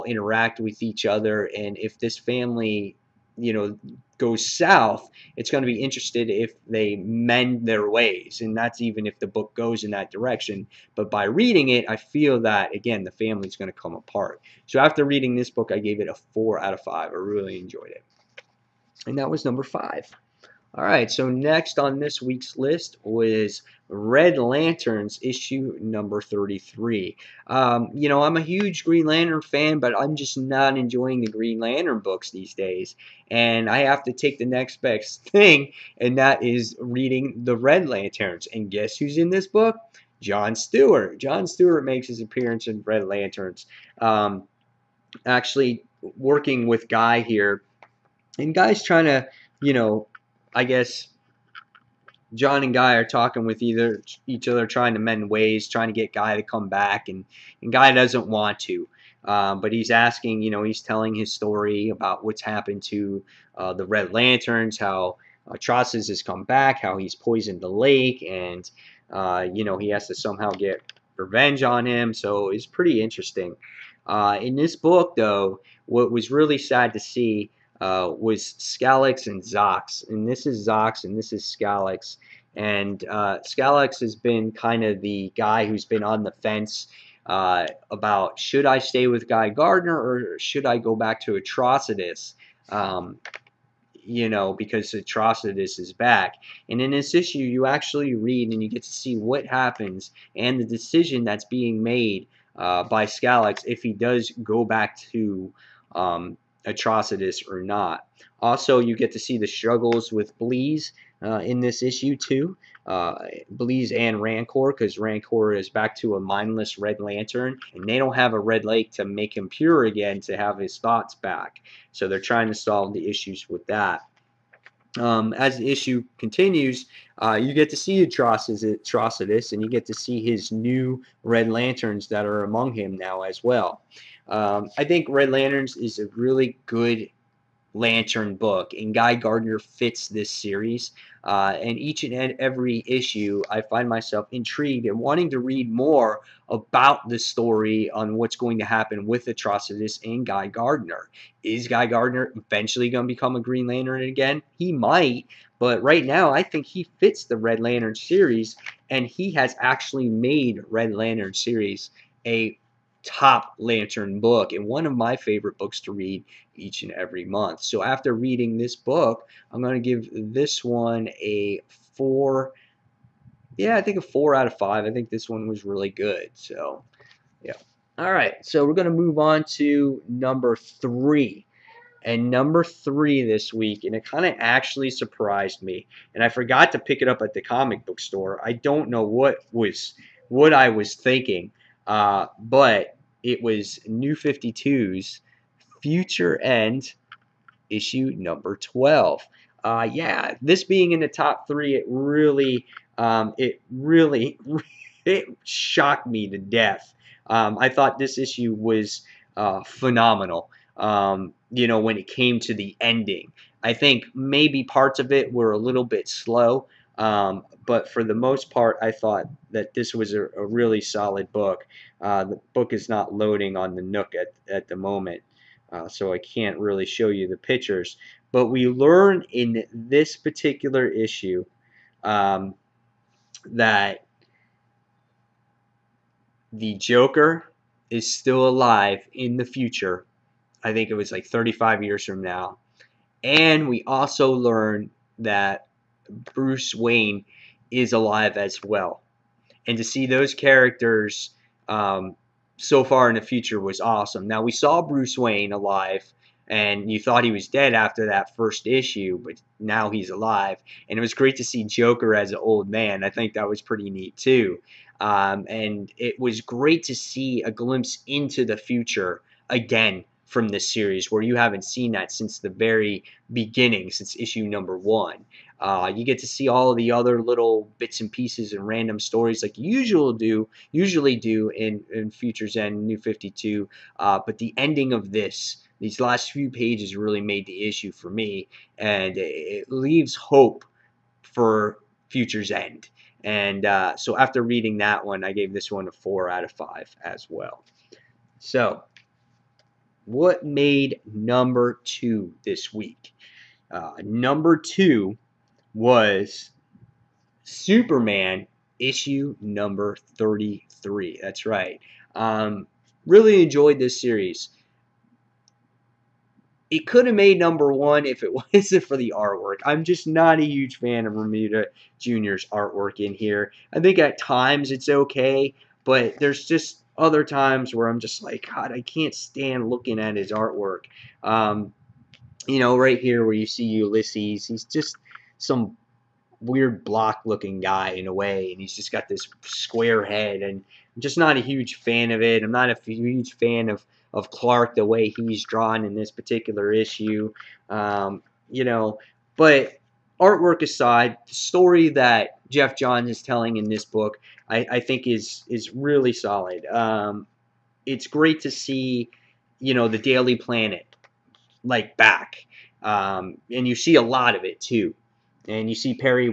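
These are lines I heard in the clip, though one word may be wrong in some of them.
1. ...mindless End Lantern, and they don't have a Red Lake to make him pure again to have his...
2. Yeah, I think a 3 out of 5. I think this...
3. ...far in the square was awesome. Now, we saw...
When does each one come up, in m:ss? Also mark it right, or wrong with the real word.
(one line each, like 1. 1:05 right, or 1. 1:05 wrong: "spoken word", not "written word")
1. 1:56 wrong: "Red", not "End"
2. 2:53 wrong: "4", not "3"
3. 4:12 wrong: "future", not "square".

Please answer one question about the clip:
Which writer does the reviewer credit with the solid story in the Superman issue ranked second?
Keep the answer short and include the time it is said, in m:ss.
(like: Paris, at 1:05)
Geoff Johns, at 5:52.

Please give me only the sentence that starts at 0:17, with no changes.
I really enjoyed it, and that was number five.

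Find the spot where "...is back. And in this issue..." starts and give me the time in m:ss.
1:35.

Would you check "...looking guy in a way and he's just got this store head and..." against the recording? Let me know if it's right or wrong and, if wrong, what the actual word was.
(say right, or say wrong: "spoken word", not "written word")
wrong: "square", not "store".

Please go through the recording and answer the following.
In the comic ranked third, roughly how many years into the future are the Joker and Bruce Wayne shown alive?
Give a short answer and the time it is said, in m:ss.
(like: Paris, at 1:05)
35, at 4:01.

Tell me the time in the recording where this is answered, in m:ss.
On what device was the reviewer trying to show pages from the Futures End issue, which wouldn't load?
3:43.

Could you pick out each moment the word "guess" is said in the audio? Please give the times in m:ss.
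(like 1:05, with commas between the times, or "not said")
0:38, 0:50.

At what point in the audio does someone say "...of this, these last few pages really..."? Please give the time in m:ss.
4:44.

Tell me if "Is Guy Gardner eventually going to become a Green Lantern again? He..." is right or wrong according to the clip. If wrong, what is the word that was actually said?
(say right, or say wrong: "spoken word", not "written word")
right.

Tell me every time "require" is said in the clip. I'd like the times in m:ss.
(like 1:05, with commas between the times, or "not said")
not said.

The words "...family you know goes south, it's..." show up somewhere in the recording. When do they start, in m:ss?
0:02.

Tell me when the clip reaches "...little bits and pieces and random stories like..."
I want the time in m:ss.
4:37.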